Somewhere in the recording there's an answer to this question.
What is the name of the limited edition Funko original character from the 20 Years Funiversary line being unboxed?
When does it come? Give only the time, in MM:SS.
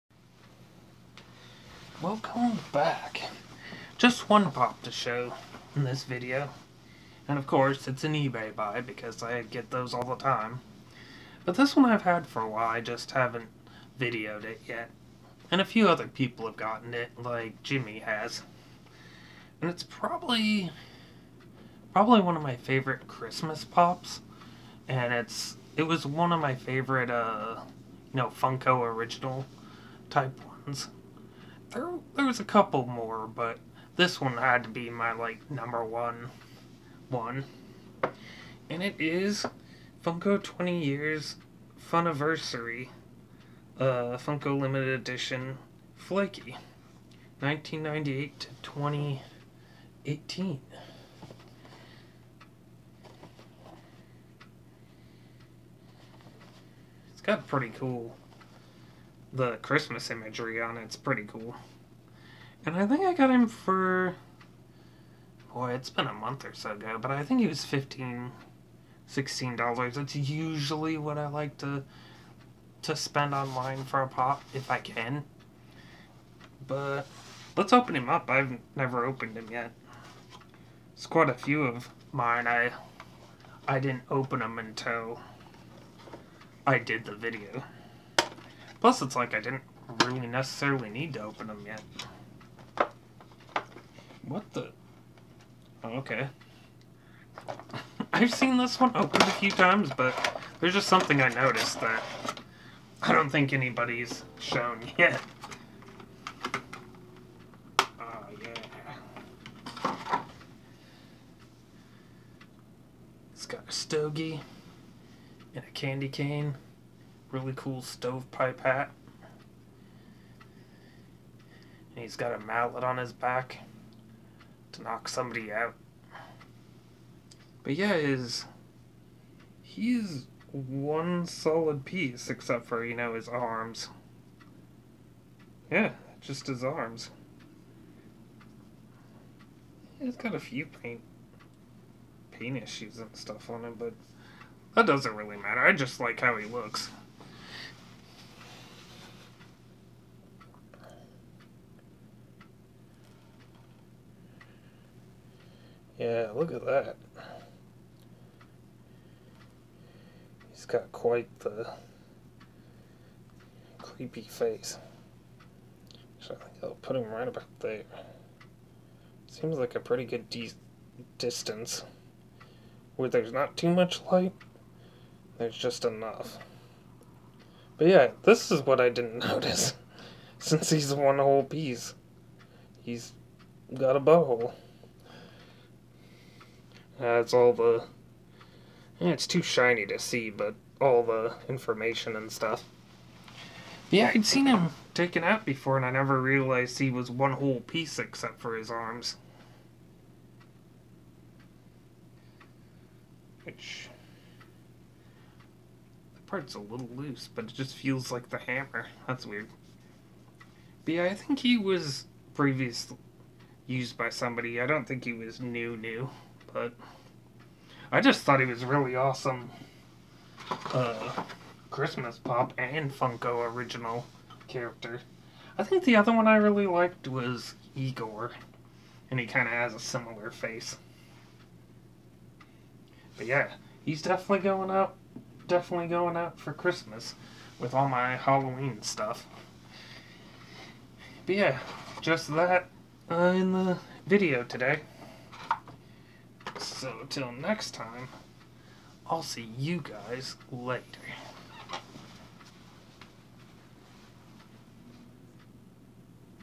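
00:45.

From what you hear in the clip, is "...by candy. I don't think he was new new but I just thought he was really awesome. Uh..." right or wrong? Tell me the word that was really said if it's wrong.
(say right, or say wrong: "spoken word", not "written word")
wrong: "somebody", not "candy".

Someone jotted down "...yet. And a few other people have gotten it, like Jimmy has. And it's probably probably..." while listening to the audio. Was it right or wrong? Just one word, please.
right.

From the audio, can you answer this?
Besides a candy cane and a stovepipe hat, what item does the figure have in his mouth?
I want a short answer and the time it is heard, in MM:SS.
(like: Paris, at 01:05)
A stogie, at 01:53.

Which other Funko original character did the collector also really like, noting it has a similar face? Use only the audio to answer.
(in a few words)
Igor.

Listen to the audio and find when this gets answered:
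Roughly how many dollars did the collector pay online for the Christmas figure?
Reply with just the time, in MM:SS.
01:07.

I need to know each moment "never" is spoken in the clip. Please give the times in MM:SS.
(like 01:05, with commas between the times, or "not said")
01:18, 03:15.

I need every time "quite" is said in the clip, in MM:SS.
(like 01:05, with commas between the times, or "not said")
01:21, 02:40.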